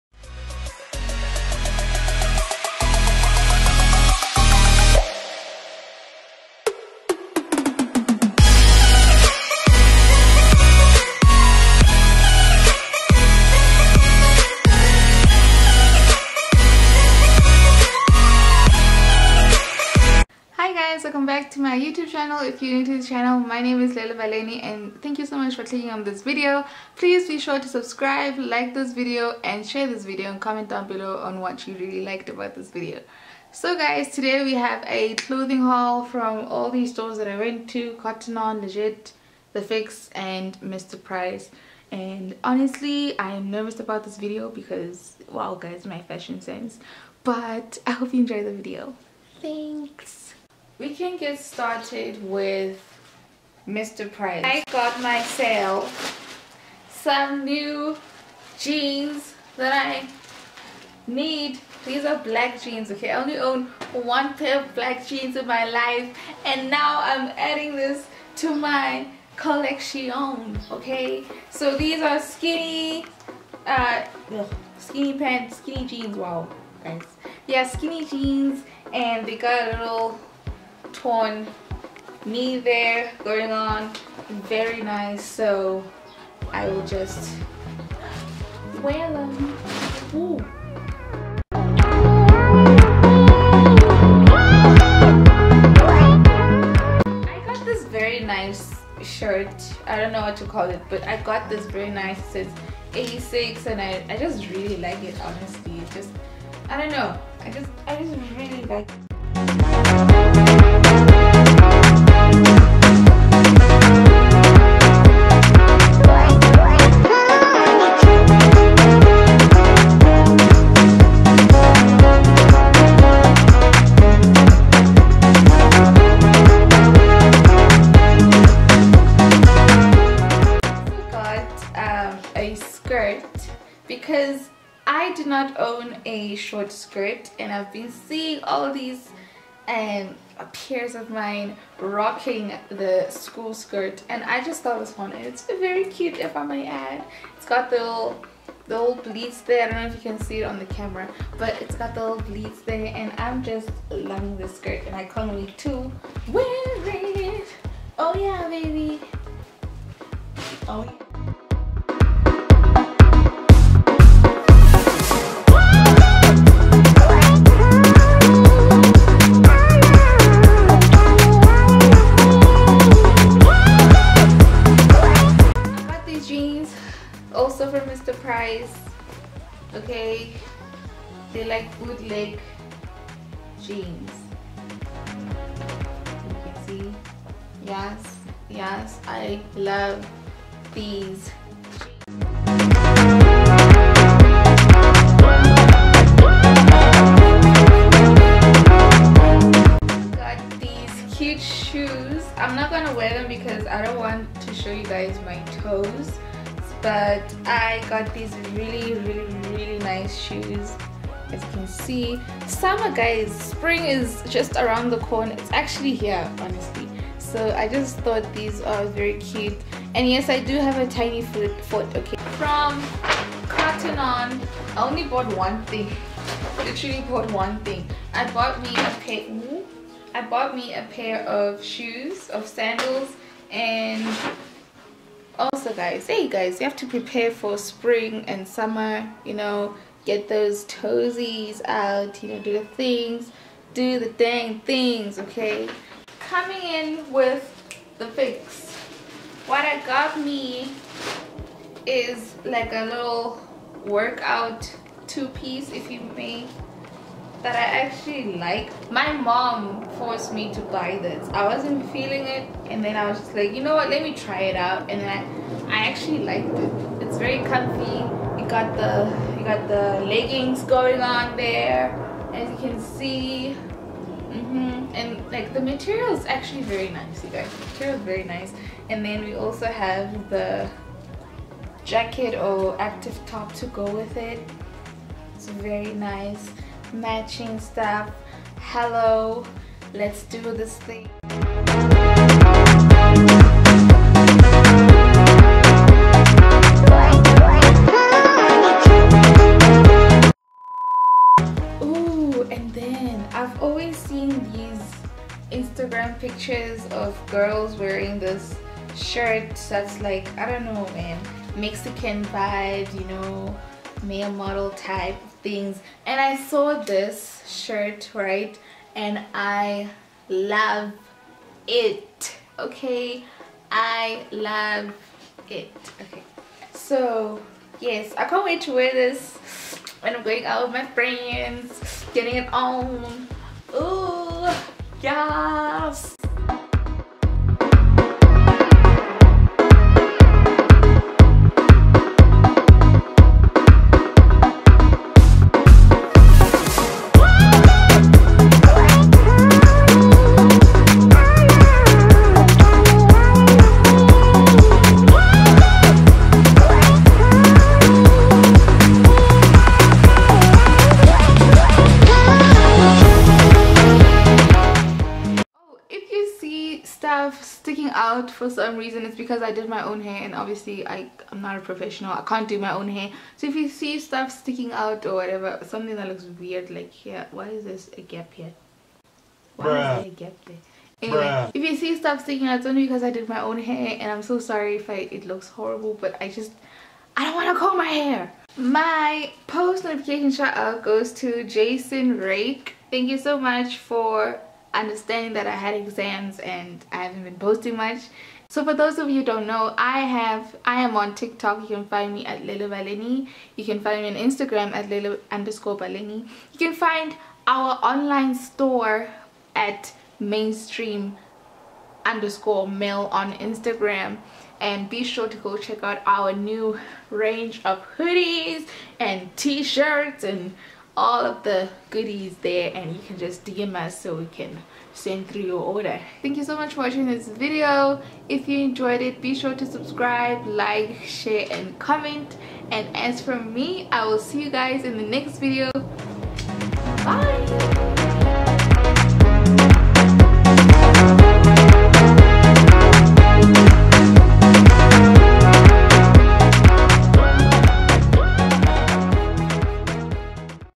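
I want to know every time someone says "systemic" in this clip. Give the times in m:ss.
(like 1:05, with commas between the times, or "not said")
not said.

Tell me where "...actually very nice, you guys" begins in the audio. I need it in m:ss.
4:36.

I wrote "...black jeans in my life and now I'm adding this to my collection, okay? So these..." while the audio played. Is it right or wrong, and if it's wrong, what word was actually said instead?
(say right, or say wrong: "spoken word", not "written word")
right.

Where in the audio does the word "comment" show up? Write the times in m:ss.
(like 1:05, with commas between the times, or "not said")
0:30, 7:11.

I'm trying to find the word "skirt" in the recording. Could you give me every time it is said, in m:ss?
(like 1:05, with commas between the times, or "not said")
2:16, 2:23, 2:34.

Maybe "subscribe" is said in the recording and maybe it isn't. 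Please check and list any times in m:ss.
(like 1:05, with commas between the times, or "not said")
0:27, 7:09.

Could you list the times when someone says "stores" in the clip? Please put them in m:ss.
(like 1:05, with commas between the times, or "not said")
0:36, 6:48.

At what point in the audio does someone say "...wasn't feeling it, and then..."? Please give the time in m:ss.
4:21.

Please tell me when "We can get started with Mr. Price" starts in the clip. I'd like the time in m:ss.
0:50.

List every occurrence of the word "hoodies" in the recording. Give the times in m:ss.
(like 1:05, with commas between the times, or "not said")
6:57.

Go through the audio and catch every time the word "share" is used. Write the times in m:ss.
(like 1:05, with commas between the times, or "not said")
0:29, 7:11.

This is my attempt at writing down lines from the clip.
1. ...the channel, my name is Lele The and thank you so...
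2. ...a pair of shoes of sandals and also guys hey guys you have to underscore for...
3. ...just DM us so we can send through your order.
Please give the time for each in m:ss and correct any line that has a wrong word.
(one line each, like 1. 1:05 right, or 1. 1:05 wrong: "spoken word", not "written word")
1. 0:22 wrong: "Baleni", not "The"
2. 3:50 wrong: "prepare", not "underscore"
3. 7:03 right.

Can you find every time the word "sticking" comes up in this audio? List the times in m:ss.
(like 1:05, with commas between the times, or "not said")
6:07, 6:14, 6:22.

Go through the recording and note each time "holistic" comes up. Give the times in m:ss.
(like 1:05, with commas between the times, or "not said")
not said.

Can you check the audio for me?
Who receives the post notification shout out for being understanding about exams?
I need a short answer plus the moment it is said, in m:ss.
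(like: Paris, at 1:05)
Jason Rake, at 6:31.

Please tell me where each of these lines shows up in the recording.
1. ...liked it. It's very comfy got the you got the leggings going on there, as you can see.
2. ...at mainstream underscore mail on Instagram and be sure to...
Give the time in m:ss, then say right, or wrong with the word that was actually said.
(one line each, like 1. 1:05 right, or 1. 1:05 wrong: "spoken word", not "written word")
1. 4:26 right
2. 6:49 right.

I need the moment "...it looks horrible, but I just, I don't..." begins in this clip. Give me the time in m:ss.
6:25.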